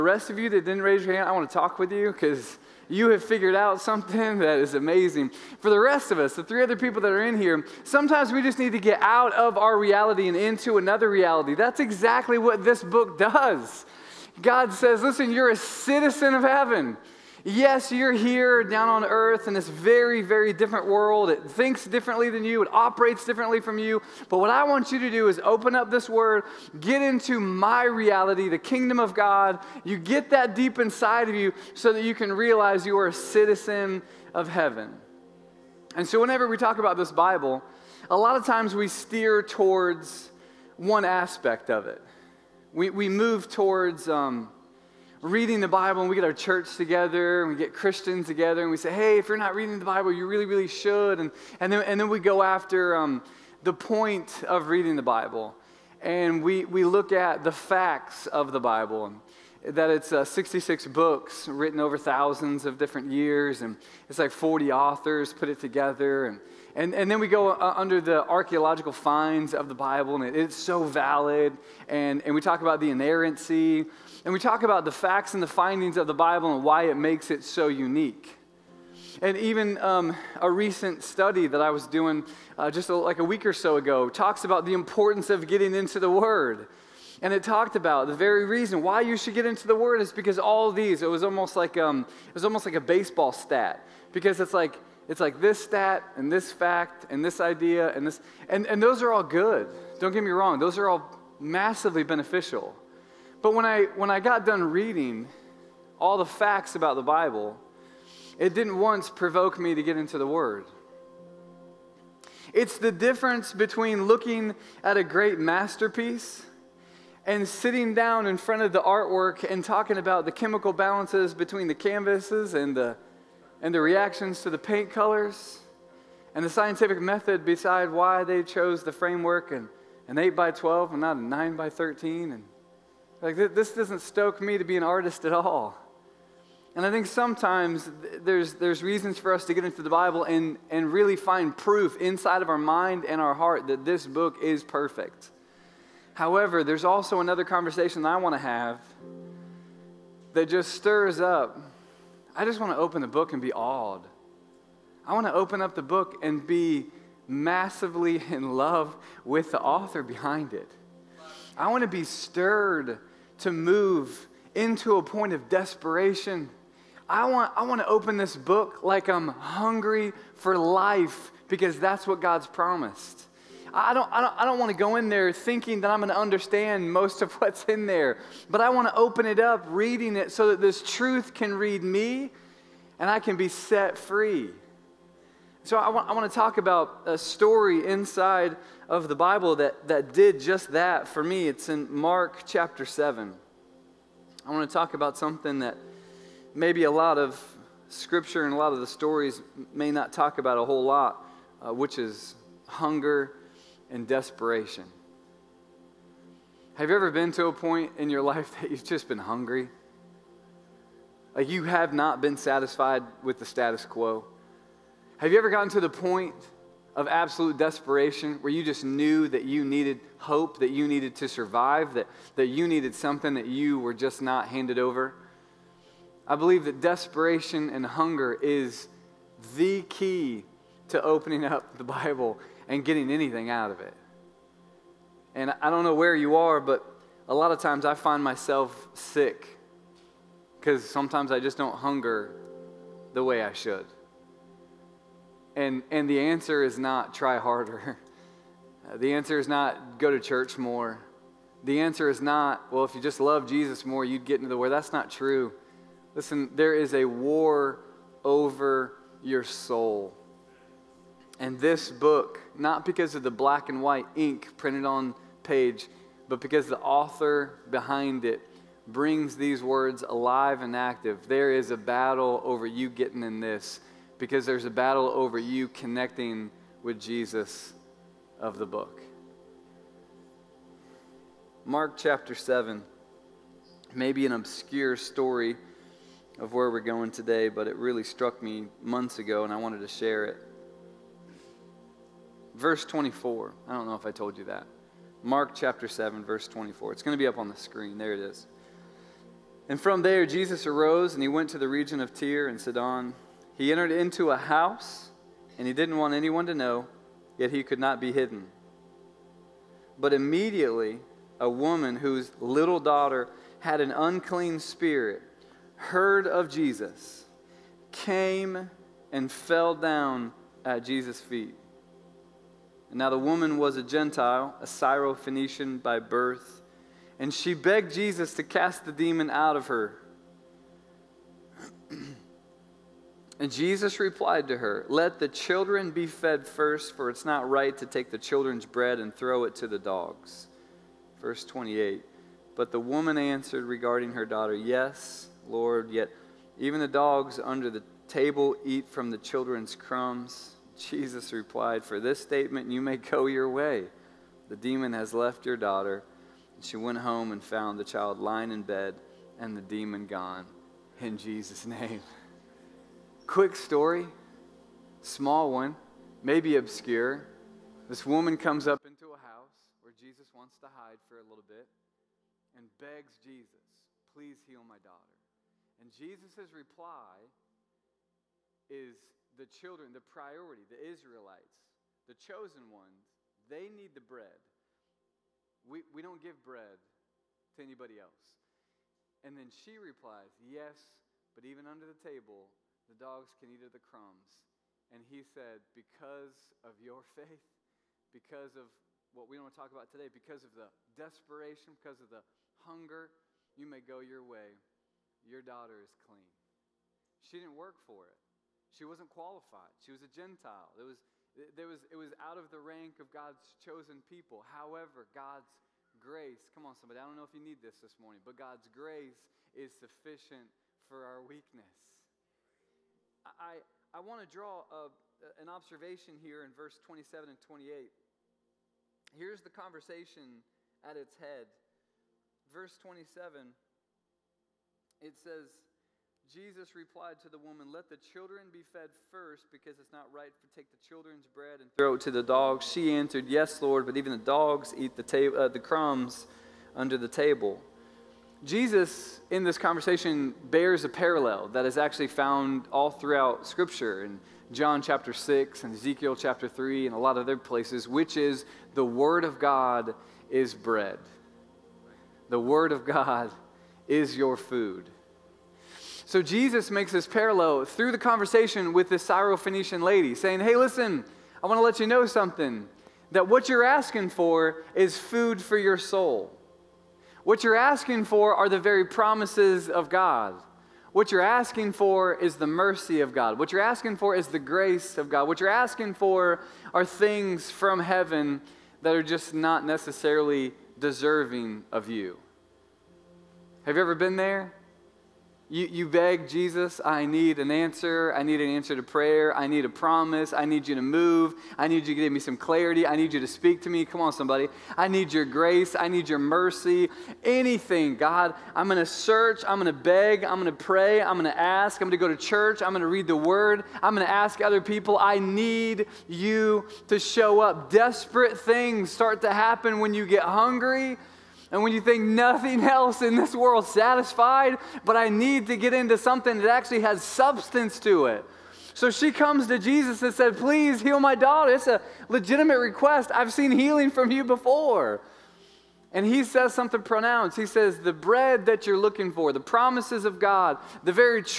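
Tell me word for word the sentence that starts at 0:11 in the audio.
That's exactly what this book does.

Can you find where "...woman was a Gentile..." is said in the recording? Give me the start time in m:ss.
5:23.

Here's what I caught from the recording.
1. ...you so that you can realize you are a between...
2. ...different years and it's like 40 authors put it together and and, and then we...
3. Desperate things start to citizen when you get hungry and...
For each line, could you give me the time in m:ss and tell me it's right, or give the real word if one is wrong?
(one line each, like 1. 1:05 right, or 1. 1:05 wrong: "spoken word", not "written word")
1. 0:31 wrong: "citizen", not "between"
2. 1:02 right
3. 8:37 wrong: "happen", not "citizen".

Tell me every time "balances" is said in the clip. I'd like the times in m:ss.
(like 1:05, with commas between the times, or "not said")
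2:00.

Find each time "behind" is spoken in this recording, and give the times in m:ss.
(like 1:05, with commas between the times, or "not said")
2:40, 4:27.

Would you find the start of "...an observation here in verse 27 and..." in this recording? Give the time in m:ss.
7:05.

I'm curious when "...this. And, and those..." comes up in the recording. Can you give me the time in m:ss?
1:38.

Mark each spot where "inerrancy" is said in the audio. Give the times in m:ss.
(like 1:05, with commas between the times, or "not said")
1:12.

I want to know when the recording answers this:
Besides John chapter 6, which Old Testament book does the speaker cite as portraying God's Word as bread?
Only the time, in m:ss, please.
7:35.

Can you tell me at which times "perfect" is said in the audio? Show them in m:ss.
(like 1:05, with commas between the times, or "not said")
2:24.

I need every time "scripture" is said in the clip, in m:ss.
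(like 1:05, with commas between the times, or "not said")
3:17, 7:33.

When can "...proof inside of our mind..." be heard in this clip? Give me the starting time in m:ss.
2:21.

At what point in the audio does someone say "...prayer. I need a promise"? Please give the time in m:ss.
8:18.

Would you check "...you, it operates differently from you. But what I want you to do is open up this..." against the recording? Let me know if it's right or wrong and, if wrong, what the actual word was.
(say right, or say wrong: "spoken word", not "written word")
right.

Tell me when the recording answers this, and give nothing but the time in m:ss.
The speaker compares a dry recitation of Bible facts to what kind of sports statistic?
1:32.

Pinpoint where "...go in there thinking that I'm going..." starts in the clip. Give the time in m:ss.
2:54.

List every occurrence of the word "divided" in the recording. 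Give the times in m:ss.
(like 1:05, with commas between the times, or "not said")
not said.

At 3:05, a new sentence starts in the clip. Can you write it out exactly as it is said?
So I want, I want to talk about a story inside of the Bible that, that did just that for me.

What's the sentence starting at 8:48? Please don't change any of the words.
So she comes to Jesus and said, Please heal my daughter.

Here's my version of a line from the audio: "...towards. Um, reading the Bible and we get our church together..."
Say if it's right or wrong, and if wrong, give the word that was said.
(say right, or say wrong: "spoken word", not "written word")
right.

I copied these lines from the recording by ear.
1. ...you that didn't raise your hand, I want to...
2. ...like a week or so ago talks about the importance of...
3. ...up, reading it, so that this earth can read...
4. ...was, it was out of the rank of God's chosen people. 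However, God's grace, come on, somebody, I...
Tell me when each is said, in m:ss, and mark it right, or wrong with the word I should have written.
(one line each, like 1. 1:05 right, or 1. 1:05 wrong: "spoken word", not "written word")
1. 0:00 right
2. 1:22 right
3. 2:59 wrong: "truth", not "earth"
4. 6:51 right.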